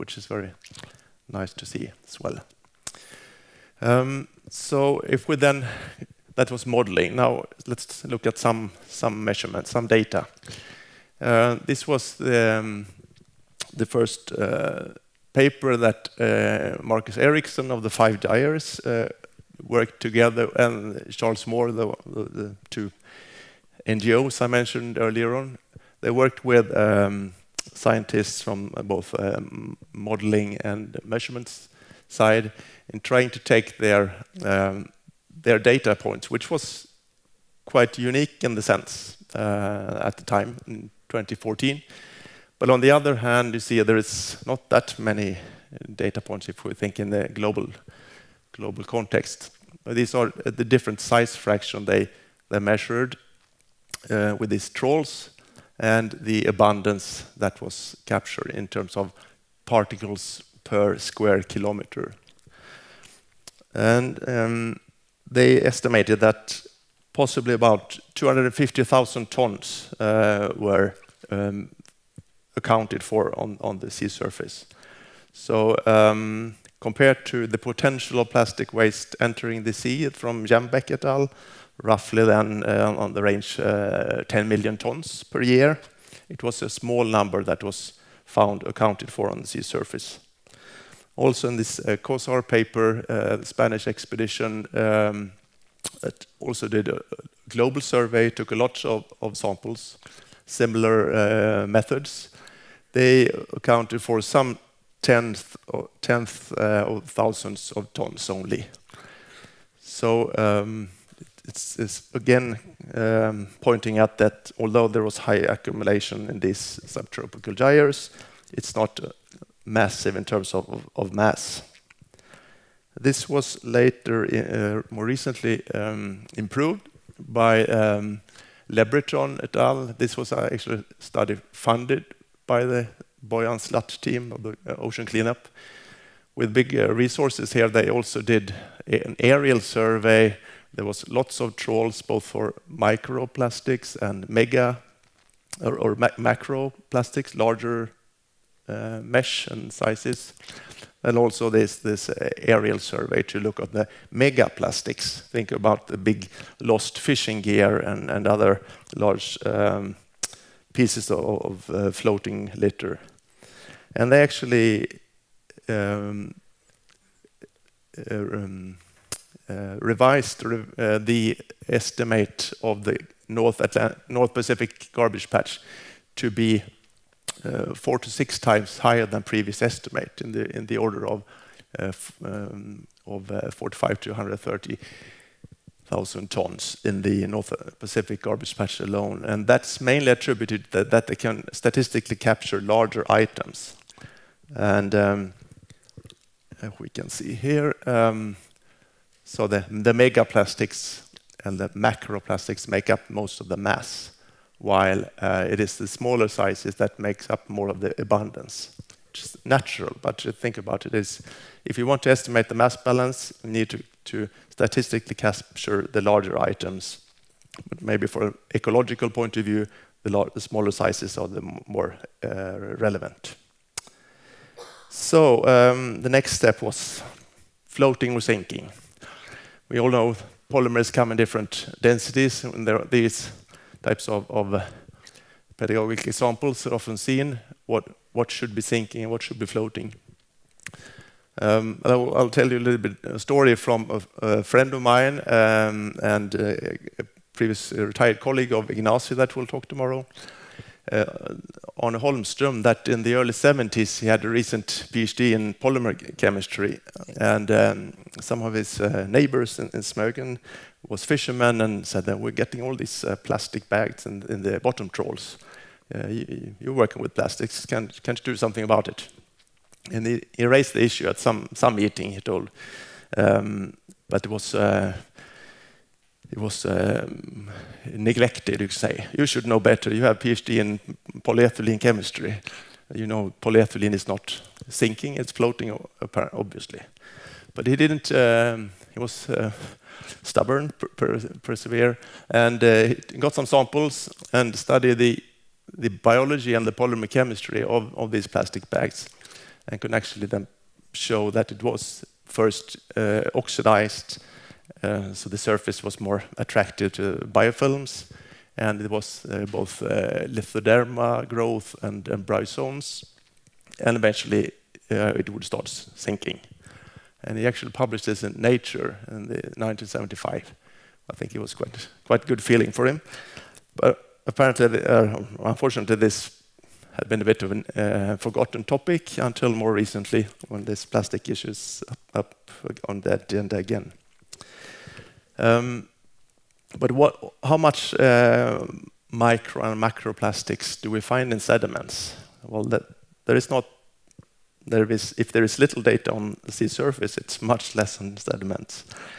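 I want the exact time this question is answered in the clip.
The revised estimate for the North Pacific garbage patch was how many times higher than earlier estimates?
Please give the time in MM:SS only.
02:57.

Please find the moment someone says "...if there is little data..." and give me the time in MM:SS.
05:45.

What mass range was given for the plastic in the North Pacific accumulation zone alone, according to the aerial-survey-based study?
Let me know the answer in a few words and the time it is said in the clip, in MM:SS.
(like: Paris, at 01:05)
45 to 130 thousand tons, at 03:03.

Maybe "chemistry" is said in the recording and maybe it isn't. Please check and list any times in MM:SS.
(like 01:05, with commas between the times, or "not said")
04:16, 04:41, 04:57.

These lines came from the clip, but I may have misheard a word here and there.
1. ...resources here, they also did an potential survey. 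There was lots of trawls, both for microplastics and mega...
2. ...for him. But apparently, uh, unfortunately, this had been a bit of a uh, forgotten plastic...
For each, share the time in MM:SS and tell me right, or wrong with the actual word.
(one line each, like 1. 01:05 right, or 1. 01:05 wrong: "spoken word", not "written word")
1. 02:16 wrong: "aerial", not "potential"
2. 05:22 wrong: "topic", not "plastic".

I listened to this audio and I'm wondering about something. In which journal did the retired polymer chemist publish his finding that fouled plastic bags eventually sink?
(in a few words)
Nature.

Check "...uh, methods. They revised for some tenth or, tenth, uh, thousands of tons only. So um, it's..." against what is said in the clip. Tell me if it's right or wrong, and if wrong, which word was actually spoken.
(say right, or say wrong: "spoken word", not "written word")
wrong: "accounted", not "revised".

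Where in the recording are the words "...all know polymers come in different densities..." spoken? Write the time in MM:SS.
03:49.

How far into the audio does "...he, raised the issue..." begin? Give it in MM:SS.
04:30.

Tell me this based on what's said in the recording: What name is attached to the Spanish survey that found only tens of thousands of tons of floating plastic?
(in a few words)
Cózar.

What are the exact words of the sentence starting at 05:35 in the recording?
Um, but what, how much uh, micro and macroplastics do we find in sediments?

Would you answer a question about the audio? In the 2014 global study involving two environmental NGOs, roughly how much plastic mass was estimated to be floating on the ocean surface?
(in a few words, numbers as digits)
250,000 tons.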